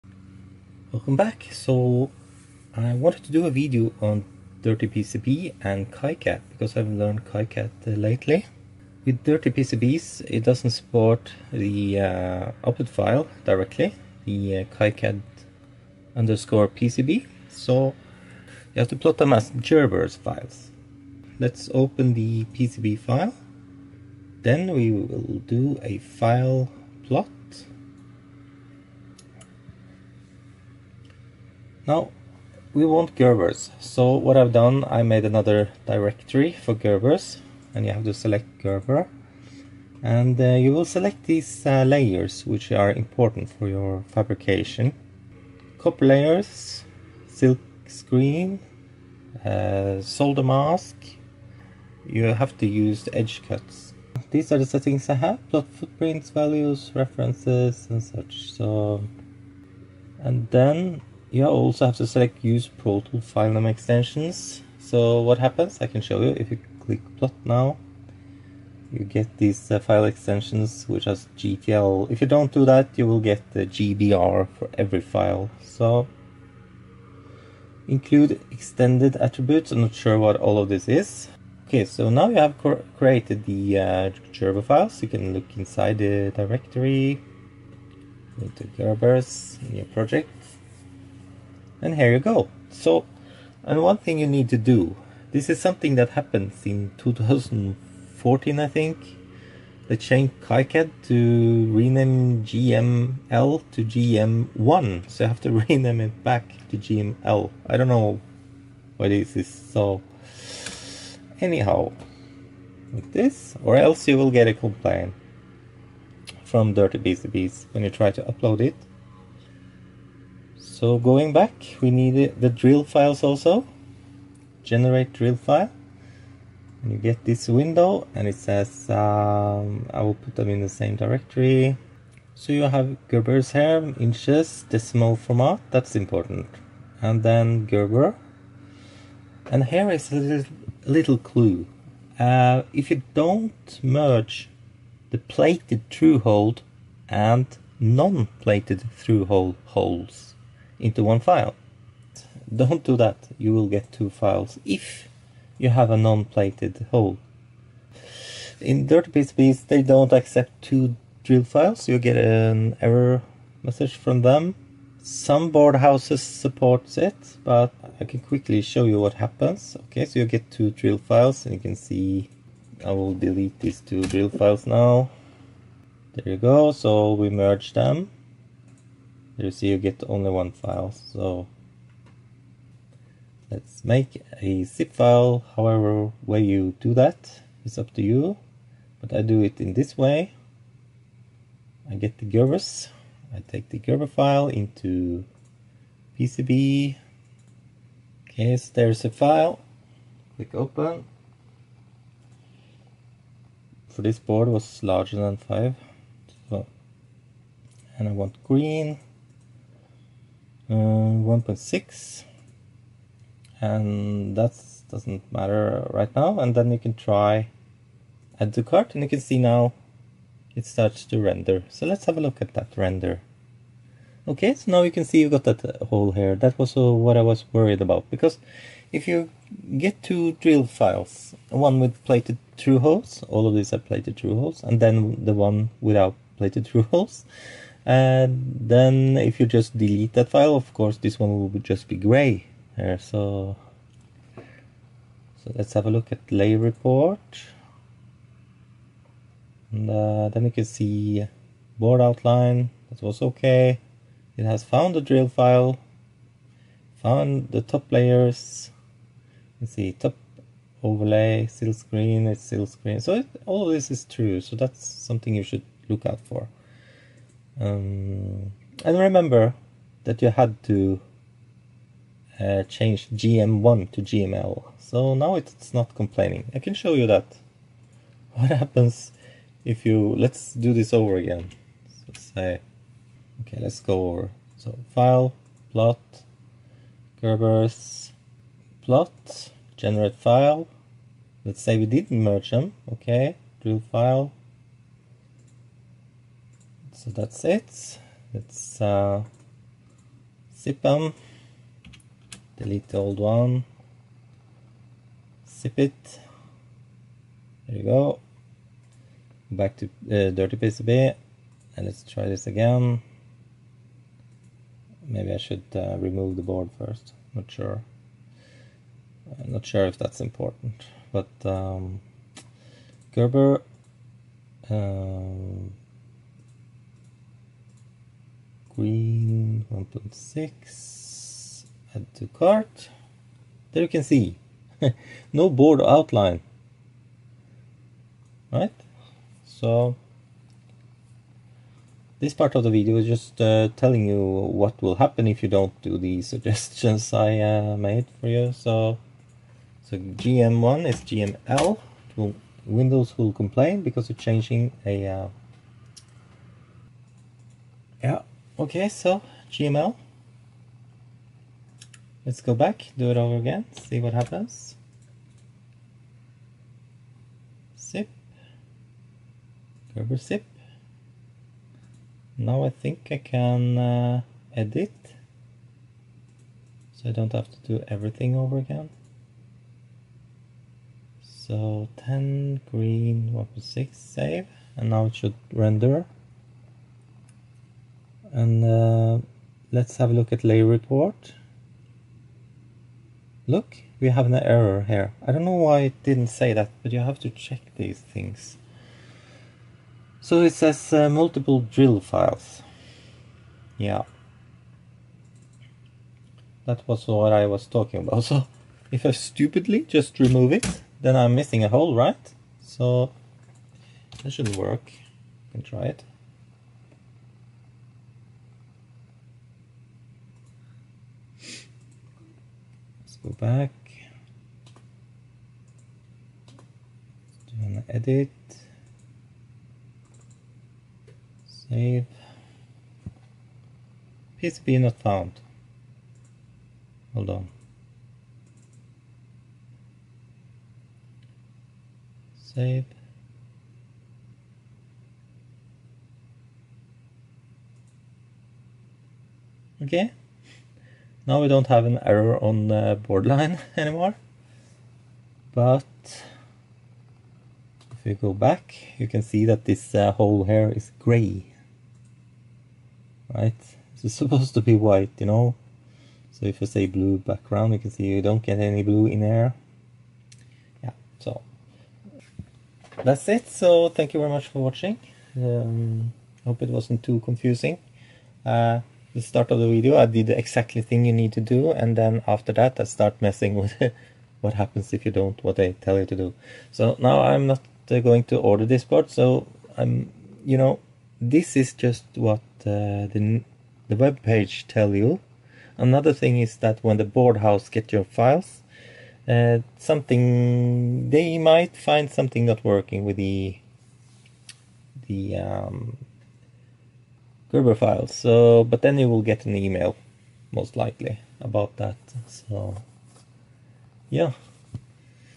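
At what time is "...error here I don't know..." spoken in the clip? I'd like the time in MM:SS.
06:34.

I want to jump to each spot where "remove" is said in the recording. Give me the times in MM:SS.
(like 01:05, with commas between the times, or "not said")
05:15, 06:50.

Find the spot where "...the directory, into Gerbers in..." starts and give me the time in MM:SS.
01:25.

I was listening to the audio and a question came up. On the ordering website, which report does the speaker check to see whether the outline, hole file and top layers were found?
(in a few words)
layer report.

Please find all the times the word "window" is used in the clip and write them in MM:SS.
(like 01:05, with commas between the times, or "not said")
02:07, 05:52.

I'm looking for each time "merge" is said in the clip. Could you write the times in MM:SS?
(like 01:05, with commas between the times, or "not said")
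02:23, 02:57, 04:52.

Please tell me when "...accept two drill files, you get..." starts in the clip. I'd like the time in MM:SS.
02:40.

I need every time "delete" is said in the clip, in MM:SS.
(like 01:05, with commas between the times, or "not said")
02:53, 03:59, 05:02.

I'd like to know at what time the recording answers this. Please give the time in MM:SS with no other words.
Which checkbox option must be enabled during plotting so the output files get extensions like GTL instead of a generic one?
01:02.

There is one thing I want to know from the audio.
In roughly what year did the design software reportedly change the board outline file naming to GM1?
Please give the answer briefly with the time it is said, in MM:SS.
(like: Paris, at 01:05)
2014, at 01:36.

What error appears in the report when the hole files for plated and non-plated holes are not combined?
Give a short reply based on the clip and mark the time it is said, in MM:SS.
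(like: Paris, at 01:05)
multiple drill files, at 06:41.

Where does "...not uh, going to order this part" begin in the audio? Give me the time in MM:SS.
08:07.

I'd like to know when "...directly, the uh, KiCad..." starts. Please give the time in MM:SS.
00:13.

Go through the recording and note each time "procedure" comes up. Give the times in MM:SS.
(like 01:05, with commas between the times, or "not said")
not said.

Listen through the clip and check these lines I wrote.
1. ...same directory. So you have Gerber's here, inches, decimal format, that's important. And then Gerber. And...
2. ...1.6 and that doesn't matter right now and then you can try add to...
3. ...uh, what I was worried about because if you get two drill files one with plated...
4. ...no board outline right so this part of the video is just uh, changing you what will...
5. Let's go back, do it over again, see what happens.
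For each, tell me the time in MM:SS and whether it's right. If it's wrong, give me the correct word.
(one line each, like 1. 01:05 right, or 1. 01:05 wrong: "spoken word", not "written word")
1. 02:10 right
2. 03:30 right
3. 03:46 right
4. 05:35 wrong: "telling", not "changing"
5. 06:02 right.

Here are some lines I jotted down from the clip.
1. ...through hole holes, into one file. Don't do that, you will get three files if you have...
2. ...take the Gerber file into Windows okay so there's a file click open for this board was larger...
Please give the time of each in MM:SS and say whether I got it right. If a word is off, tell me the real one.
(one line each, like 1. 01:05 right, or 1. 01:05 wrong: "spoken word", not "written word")
1. 02:28 wrong: "two", not "three"
2. 03:13 wrong: "PCB", not "Windows".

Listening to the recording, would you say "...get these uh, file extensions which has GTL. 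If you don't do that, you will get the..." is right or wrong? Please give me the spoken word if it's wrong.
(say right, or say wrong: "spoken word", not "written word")
right.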